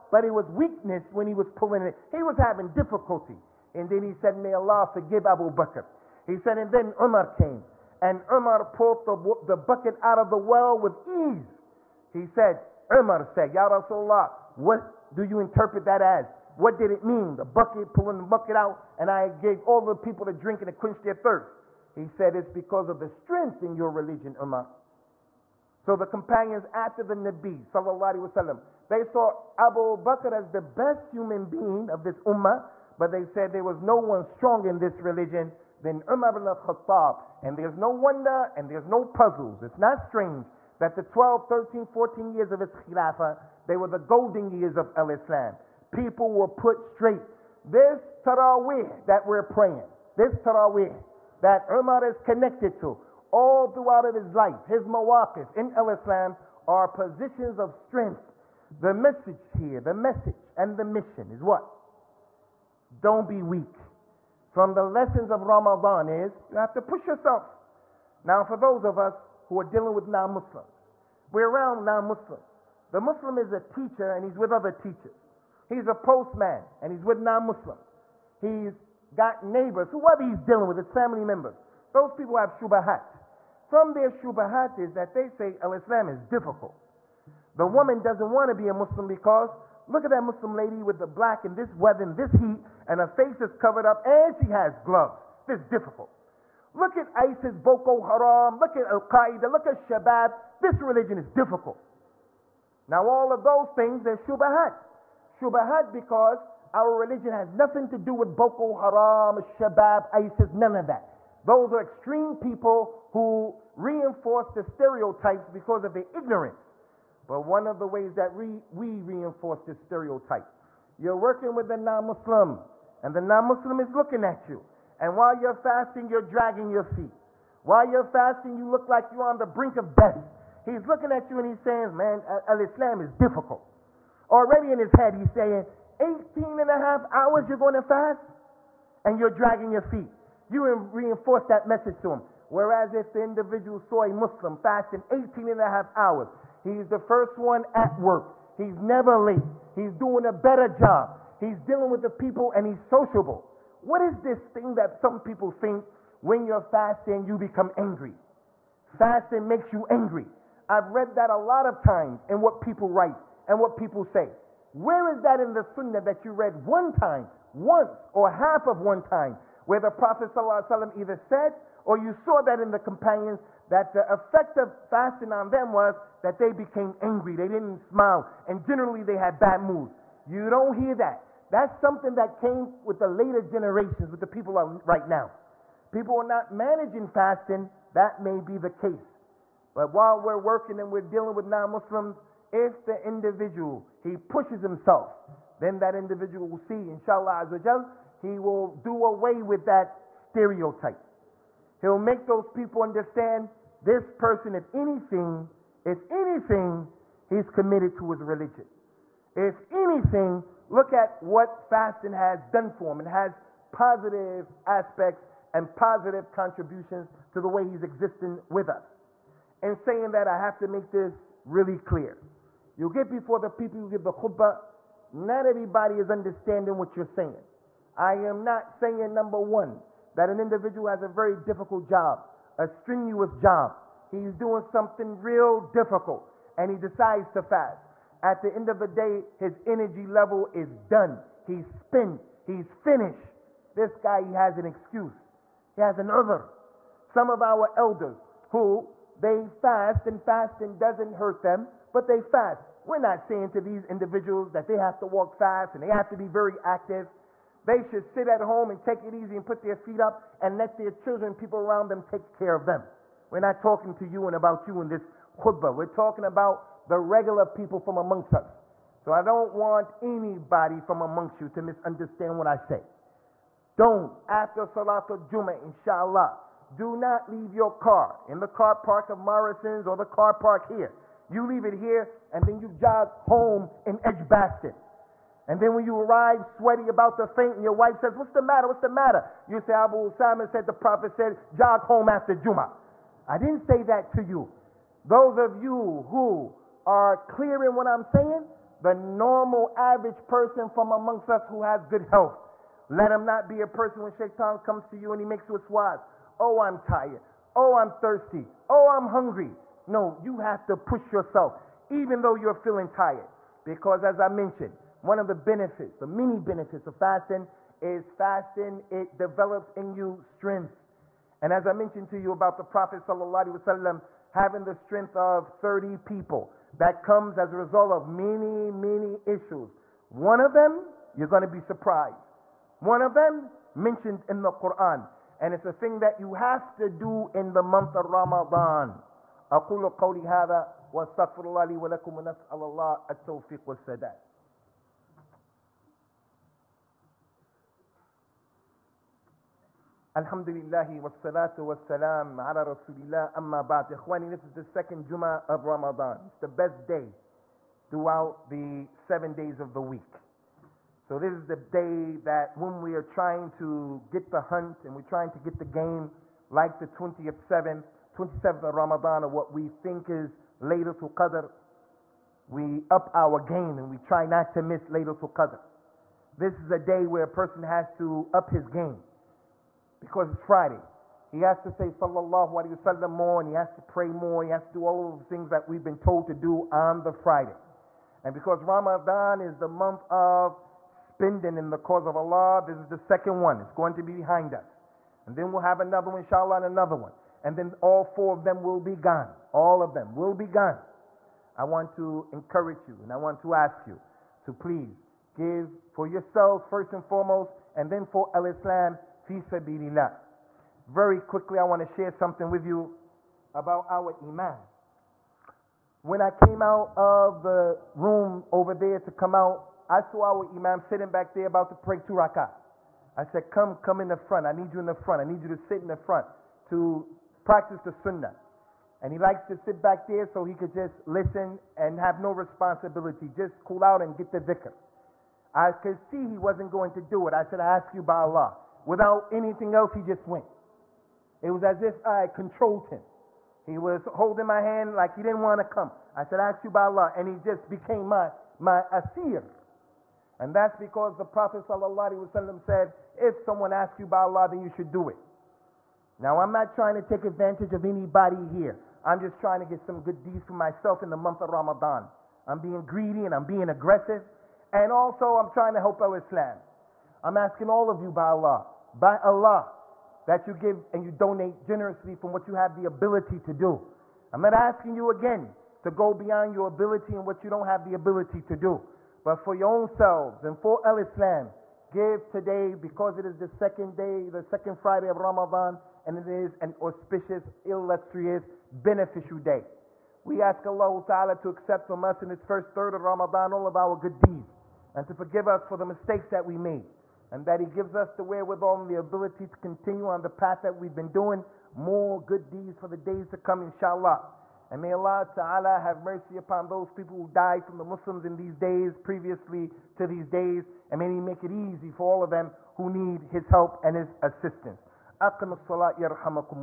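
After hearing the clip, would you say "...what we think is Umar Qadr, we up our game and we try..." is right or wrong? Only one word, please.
wrong.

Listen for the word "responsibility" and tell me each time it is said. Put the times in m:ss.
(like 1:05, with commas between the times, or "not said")
7:12.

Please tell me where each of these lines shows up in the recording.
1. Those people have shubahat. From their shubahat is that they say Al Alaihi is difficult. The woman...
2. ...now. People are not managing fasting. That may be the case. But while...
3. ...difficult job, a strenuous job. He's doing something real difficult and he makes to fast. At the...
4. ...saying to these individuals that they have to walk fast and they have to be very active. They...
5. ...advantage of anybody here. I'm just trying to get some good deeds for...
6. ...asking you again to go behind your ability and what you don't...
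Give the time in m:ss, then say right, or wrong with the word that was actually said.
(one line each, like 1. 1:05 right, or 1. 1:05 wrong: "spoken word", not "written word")
1. 1:21 wrong: "Islam", not "Alaihi"
2. 3:05 right
3. 3:51 wrong: "decides", not "makes"
4. 4:13 right
5. 7:37 right
6. 7:54 wrong: "beyond", not "behind".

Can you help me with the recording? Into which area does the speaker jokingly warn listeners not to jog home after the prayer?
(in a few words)
Edgbaston.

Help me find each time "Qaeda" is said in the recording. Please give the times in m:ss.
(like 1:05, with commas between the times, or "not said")
1:39.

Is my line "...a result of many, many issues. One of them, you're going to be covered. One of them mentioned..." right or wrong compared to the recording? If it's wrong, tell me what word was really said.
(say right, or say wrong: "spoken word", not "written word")
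wrong: "surprised", not "covered".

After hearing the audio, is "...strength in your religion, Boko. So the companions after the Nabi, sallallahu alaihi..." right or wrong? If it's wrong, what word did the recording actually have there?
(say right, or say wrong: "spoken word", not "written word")
wrong: "Umar", not "Boko".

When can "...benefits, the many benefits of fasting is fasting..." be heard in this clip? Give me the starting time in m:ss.
5:15.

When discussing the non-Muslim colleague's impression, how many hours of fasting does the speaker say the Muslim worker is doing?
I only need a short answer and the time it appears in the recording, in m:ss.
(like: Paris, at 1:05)
18 and a half, at 2:16.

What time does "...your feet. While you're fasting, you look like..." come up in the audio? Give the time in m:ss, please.
2:06.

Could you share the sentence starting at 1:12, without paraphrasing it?
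The Muslim is a teacher and he's with other teachers.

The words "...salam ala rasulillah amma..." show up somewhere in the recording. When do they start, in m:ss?
5:51.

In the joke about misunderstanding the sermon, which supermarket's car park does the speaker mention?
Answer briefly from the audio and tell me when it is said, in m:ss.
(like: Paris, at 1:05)
Morrison's, at 4:39.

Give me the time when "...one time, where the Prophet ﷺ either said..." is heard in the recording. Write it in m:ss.
2:48.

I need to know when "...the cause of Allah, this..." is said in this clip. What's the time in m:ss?
6:31.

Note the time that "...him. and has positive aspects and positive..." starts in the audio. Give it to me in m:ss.
3:32.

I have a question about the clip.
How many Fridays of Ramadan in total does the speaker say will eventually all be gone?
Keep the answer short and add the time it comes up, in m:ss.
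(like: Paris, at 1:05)
4, at 6:38.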